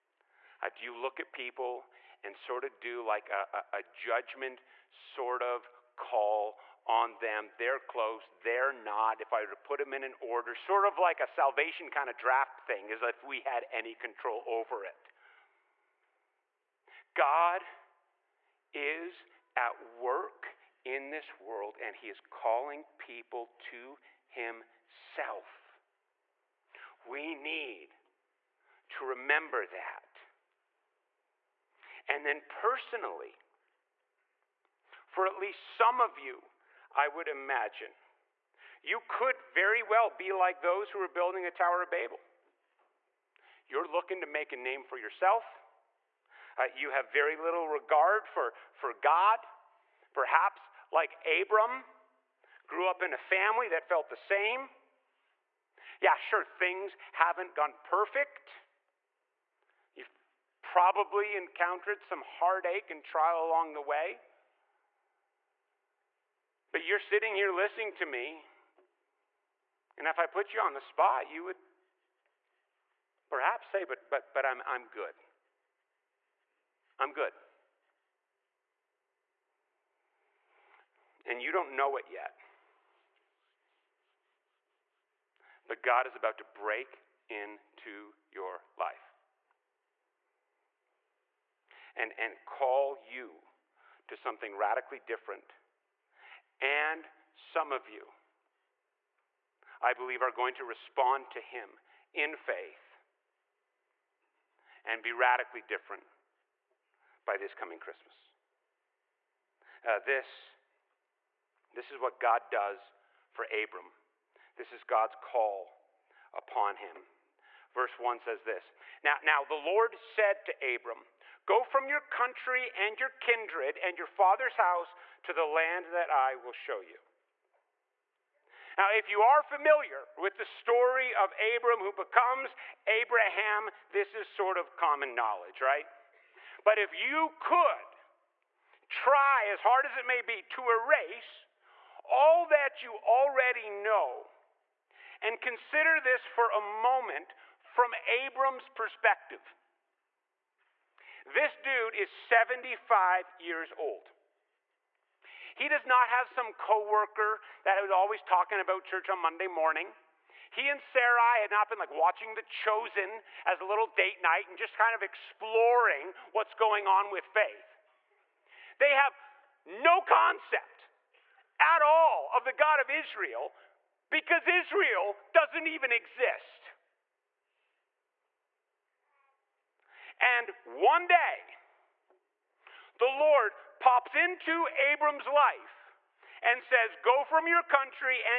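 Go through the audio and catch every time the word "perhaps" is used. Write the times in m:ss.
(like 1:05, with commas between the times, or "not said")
0:50, 1:13.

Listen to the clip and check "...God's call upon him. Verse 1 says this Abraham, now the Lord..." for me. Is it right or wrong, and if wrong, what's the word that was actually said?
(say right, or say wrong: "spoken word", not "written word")
wrong: "Now", not "Abraham".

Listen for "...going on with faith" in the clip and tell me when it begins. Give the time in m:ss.
2:46.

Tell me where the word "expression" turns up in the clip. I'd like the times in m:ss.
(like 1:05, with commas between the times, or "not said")
not said.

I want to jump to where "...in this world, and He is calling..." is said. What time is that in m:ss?
0:20.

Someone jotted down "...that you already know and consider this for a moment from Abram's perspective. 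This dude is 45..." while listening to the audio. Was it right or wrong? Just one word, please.
wrong.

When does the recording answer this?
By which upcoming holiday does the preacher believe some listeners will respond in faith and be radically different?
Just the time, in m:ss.
1:47.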